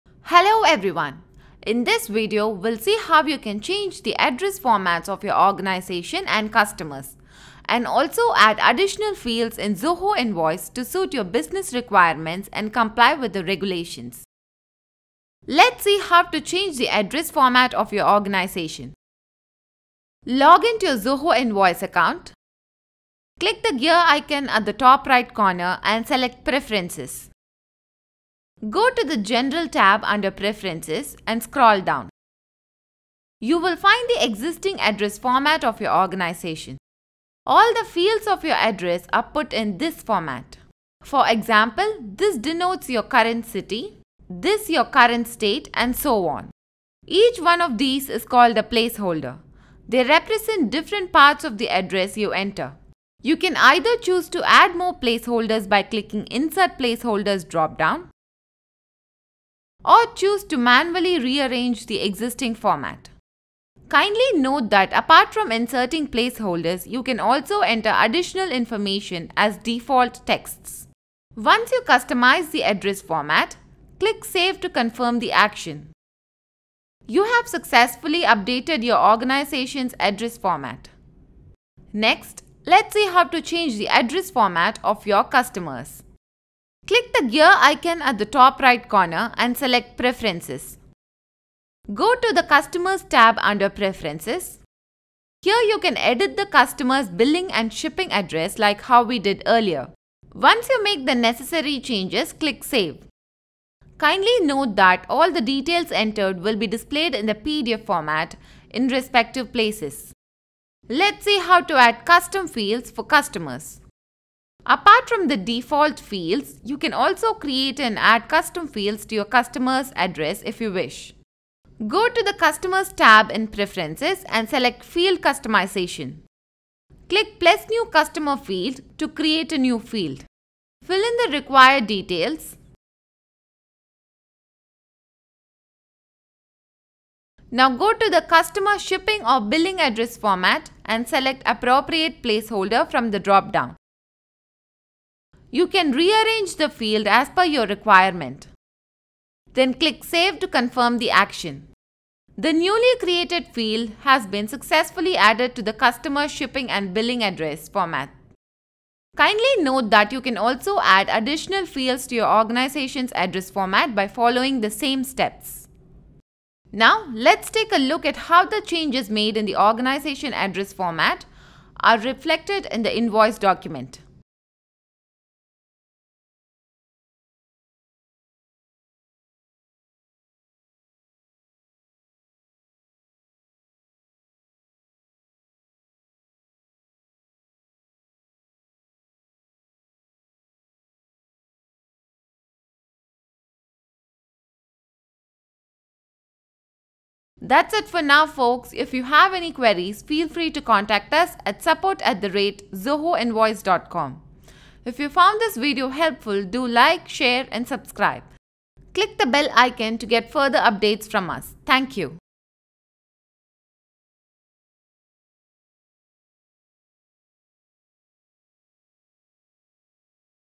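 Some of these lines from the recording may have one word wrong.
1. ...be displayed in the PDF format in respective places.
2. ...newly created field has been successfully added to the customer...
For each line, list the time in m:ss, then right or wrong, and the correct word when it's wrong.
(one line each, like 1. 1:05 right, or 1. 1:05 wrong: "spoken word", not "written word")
1. 1:46 right
2. 2:32 right.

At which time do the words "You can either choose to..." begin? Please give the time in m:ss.
0:53.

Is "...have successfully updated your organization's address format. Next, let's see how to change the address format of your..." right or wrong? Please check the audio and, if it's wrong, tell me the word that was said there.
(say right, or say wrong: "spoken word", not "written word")
right.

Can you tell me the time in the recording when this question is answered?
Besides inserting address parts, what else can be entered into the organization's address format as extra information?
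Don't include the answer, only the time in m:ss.
1:09.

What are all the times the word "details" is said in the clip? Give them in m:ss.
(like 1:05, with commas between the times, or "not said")
1:45, 2:11.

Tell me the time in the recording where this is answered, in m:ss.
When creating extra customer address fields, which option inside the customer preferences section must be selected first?
2:04.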